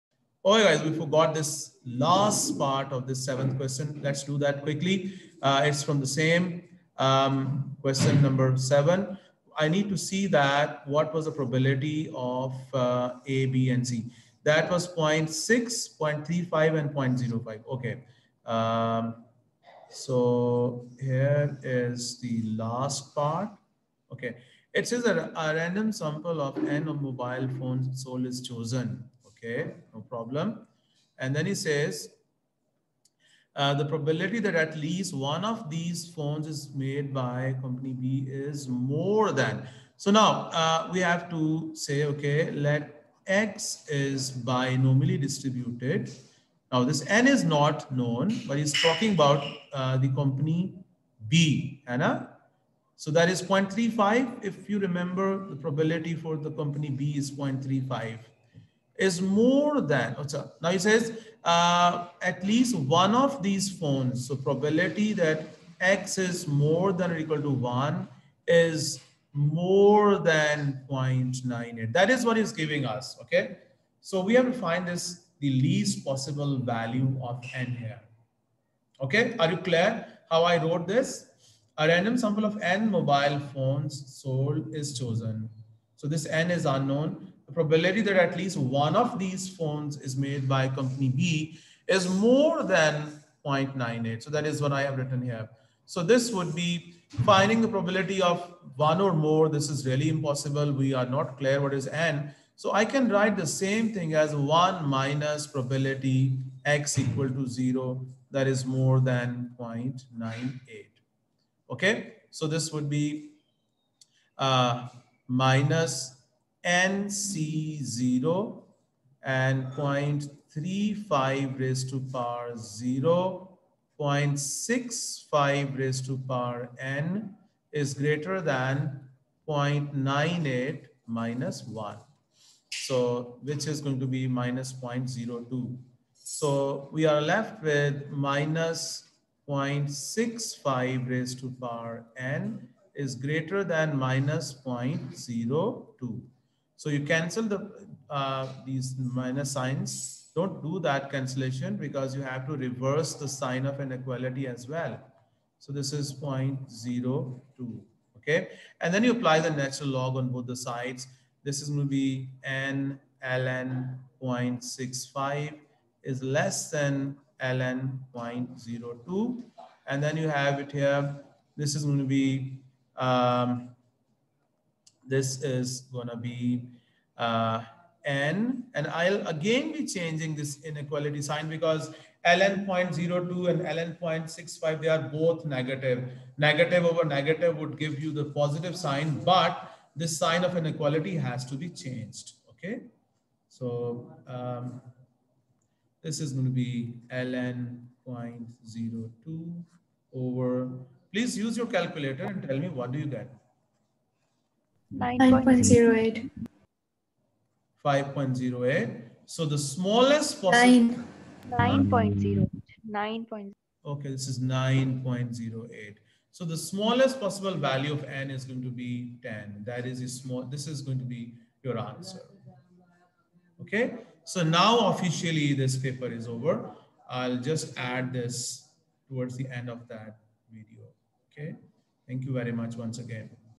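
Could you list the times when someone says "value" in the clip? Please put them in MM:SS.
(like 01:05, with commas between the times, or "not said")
01:16, 03:37.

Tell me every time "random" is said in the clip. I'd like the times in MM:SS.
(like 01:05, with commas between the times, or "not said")
00:25, 01:21.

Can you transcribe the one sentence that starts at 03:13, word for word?
So um, this is going to be ln 0.02 over, please use your calculator and tell me what do you get?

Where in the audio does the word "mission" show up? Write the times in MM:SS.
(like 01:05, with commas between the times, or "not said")
not said.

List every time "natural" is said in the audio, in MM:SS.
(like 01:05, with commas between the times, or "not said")
02:39.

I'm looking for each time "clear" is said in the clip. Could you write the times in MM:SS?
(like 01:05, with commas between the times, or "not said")
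01:19, 01:41.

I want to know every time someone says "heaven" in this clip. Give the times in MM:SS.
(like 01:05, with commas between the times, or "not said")
not said.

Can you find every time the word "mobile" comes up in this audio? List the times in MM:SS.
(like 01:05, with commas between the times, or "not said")
00:26, 01:22.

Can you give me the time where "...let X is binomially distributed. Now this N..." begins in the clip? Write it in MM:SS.
00:42.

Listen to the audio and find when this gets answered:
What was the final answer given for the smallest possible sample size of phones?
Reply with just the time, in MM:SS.
03:39.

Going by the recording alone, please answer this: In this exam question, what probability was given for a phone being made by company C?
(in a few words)
0.05.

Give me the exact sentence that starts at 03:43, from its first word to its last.
Okay, so now officially this paper is over.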